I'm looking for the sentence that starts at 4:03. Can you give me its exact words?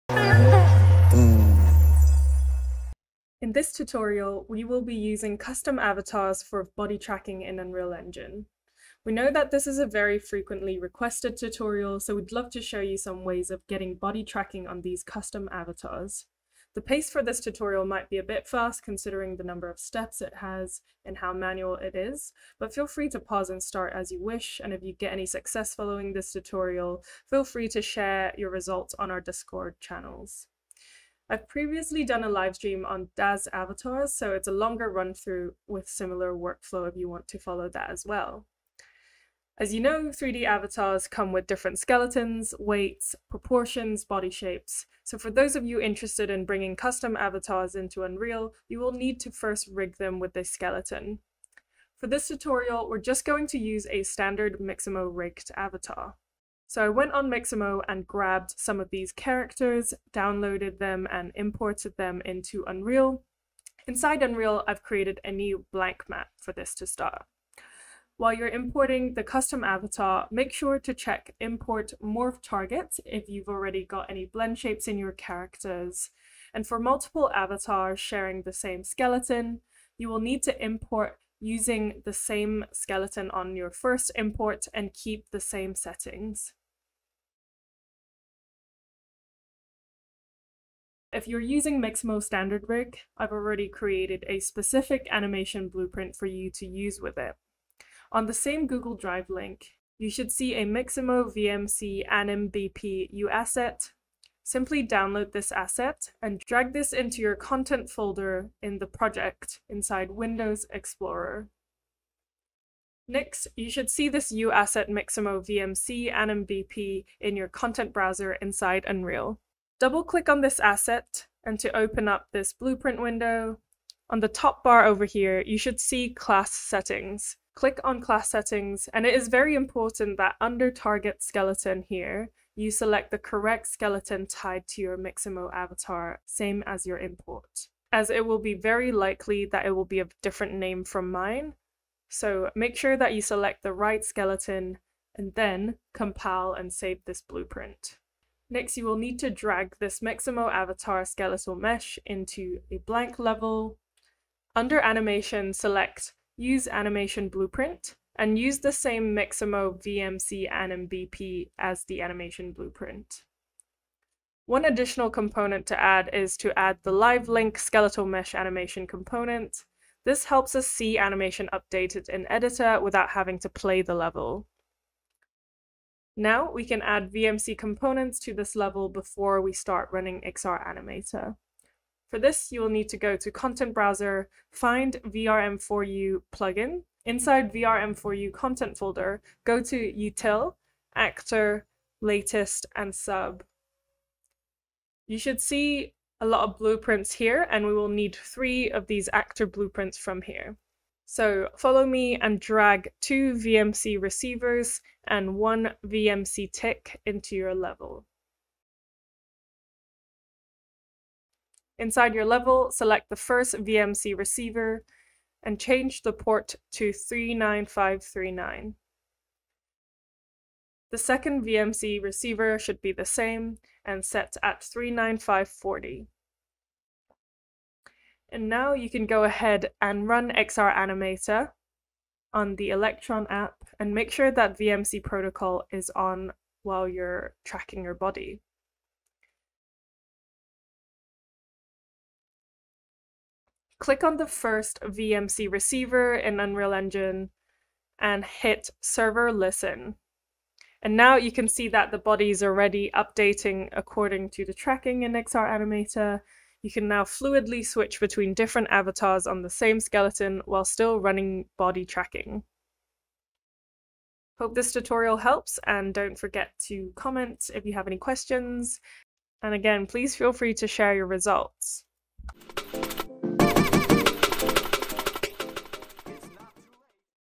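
Click on the first VMC receiver in Unreal Engine and hit server listen.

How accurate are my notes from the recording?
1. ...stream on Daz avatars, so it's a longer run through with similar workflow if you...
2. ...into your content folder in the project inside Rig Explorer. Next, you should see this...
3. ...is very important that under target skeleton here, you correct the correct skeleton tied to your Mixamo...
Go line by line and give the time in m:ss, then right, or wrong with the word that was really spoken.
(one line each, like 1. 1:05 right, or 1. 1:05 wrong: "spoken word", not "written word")
1. 0:32 right
2. 1:46 wrong: "Windows", not "Rig"
3. 2:09 wrong: "select", not "correct".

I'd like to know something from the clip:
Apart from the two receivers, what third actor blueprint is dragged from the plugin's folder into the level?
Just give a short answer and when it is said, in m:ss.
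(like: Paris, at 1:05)
VMC tick, at 3:25.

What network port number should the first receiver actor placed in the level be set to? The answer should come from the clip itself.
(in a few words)
39539.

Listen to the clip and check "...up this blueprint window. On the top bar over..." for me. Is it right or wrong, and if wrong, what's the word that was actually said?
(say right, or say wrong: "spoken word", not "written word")
right.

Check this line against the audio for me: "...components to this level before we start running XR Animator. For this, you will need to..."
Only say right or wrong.
right.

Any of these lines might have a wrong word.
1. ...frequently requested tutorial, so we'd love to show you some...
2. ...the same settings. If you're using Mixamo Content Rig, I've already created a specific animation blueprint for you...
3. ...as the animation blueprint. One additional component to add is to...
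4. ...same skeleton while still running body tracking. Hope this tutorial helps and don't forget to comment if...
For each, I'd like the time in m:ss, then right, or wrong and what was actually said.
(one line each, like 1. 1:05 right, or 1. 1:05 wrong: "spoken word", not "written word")
1. 0:10 right
2. 1:25 wrong: "Standard", not "Content"
3. 2:41 right
4. 4:19 right.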